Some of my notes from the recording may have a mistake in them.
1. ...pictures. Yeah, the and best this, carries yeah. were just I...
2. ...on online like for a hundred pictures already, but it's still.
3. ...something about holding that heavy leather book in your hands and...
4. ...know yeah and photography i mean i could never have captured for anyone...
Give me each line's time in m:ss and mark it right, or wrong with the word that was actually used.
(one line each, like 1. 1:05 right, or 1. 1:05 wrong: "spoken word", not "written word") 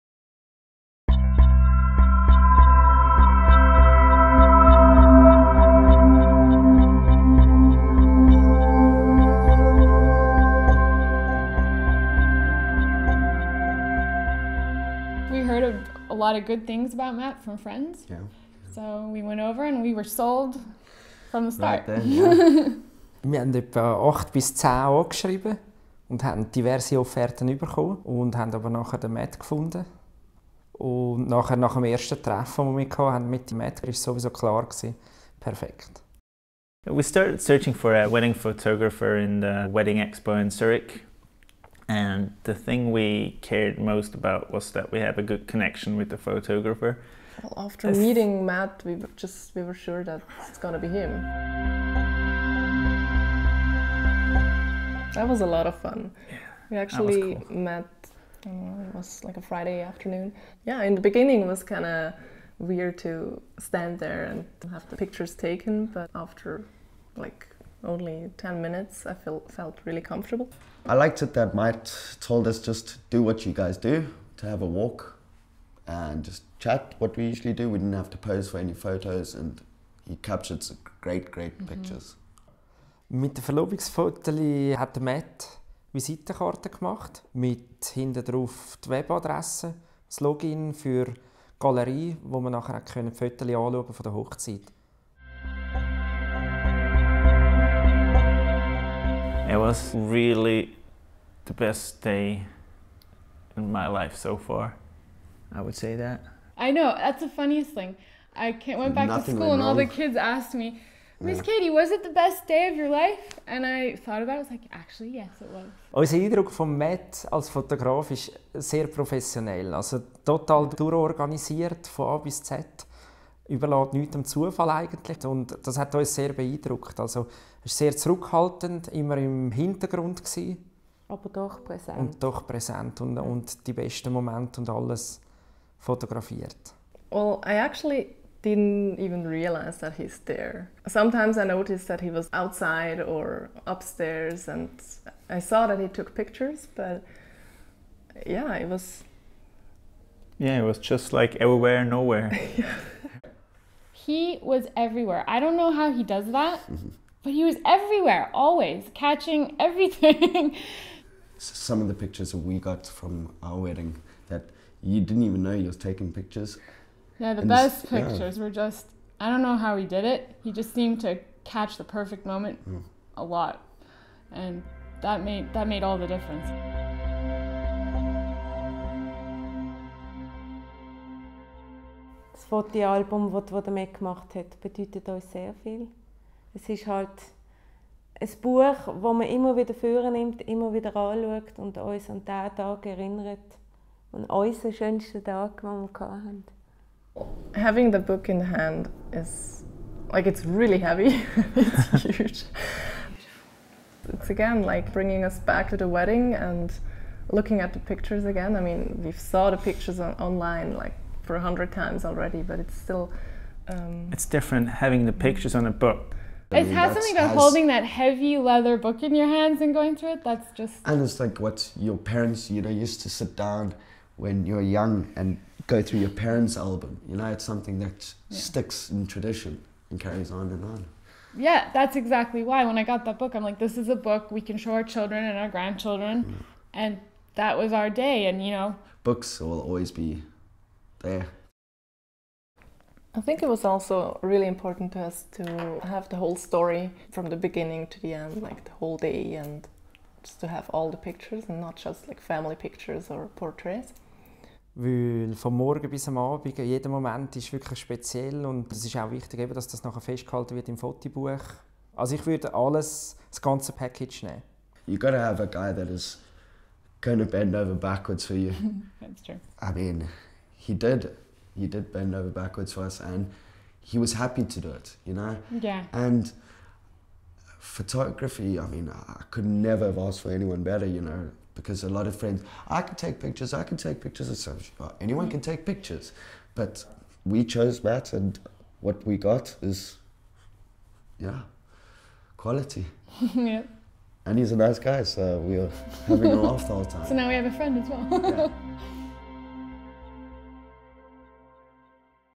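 1. 2:46 wrong: "pictures", not "carries"
2. 3:30 wrong: "times", not "pictures"
3. 3:36 right
4. 4:35 wrong: "asked", not "captured".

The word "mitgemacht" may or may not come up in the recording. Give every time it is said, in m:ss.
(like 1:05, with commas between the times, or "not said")
3:03.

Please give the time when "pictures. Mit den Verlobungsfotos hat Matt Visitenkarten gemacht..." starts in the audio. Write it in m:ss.
1:21.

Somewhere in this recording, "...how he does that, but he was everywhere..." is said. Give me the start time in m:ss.
2:35.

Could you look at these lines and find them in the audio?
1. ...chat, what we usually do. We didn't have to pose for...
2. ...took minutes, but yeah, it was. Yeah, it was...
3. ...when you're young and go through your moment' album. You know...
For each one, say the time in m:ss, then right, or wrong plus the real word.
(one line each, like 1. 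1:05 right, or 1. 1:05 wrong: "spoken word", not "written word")
1. 1:16 right
2. 2:25 wrong: "pictures", not "minutes"
3. 3:44 wrong: "parents", not "moment".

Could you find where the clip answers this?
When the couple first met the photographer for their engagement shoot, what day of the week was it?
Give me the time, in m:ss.
0:59.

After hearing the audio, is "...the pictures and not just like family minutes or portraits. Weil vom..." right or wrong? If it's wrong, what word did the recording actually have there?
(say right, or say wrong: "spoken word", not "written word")
wrong: "pictures", not "minutes".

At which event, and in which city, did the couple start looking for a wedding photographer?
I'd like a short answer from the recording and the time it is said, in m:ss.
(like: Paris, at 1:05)
Wedding Expo in Zurich, at 0:39.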